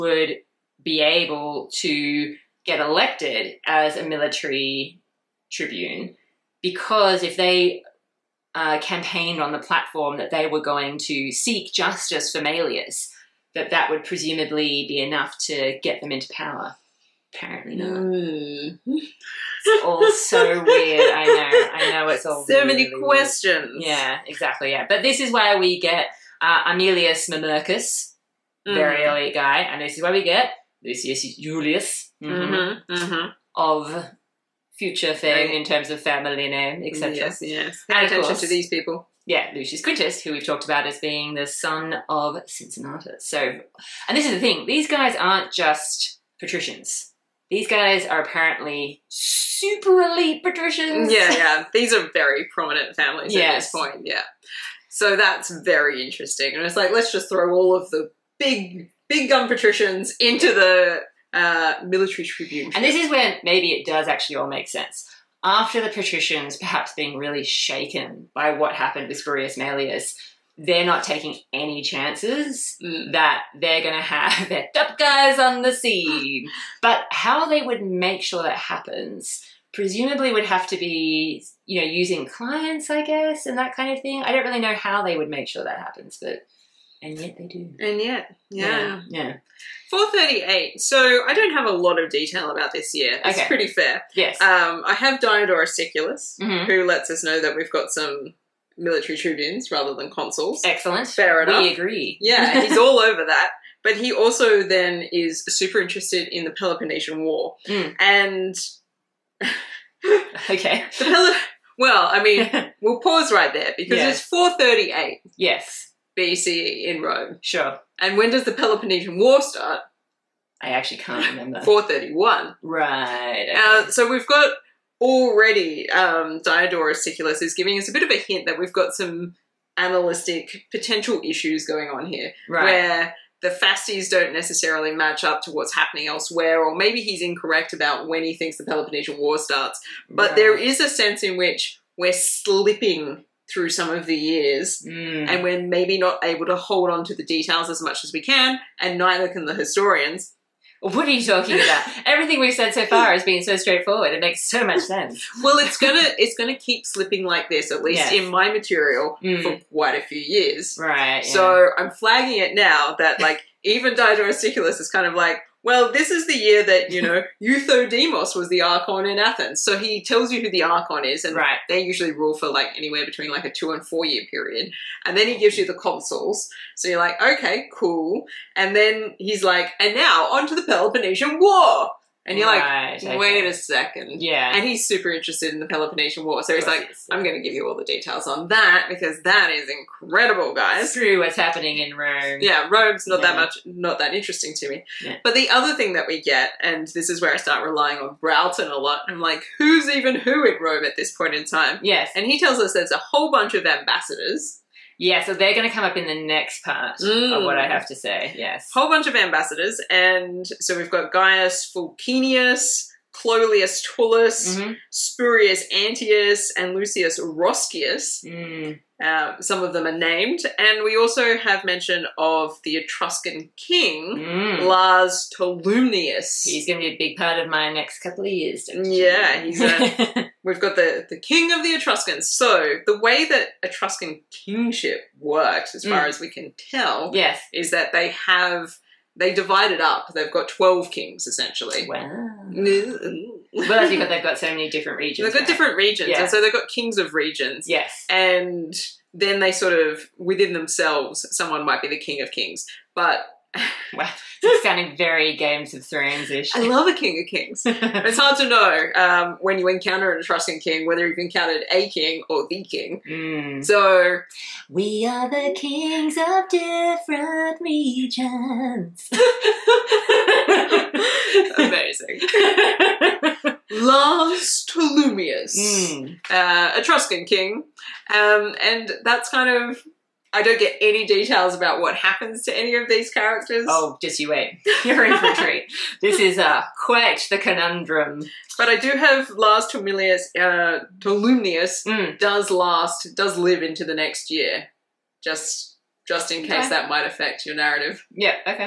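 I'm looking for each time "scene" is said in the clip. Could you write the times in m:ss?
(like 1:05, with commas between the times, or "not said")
1:15.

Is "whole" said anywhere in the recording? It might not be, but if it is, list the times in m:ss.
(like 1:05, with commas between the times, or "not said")
3:22, 3:28.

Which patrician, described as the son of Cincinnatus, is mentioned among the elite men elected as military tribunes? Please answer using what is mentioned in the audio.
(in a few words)
Lucius Quintus.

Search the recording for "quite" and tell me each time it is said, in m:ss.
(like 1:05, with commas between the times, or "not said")
2:39, 4:46.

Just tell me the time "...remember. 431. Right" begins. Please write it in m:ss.
2:01.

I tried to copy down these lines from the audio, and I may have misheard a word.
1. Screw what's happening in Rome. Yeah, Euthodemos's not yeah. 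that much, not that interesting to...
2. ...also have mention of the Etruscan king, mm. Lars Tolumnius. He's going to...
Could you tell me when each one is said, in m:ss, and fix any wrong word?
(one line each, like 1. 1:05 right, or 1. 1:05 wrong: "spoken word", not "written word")
1. 3:10 wrong: "Rome", not "Euthodemos"
2. 3:40 right.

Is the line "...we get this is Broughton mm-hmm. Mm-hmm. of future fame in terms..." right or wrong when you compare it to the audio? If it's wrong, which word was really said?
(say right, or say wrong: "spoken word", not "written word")
wrong: "Julius", not "Broughton".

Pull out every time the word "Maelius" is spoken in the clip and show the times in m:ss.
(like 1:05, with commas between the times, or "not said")
0:12, 1:09.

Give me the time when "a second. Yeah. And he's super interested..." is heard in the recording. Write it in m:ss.
3:03.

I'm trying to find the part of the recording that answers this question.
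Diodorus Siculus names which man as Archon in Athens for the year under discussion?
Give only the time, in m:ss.
2:47.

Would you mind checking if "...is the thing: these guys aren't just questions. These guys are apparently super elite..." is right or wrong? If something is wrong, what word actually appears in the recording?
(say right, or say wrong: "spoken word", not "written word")
wrong: "patricians", not "questions".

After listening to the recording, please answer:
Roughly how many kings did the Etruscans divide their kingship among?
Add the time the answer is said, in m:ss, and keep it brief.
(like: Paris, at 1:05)
12, at 4:00.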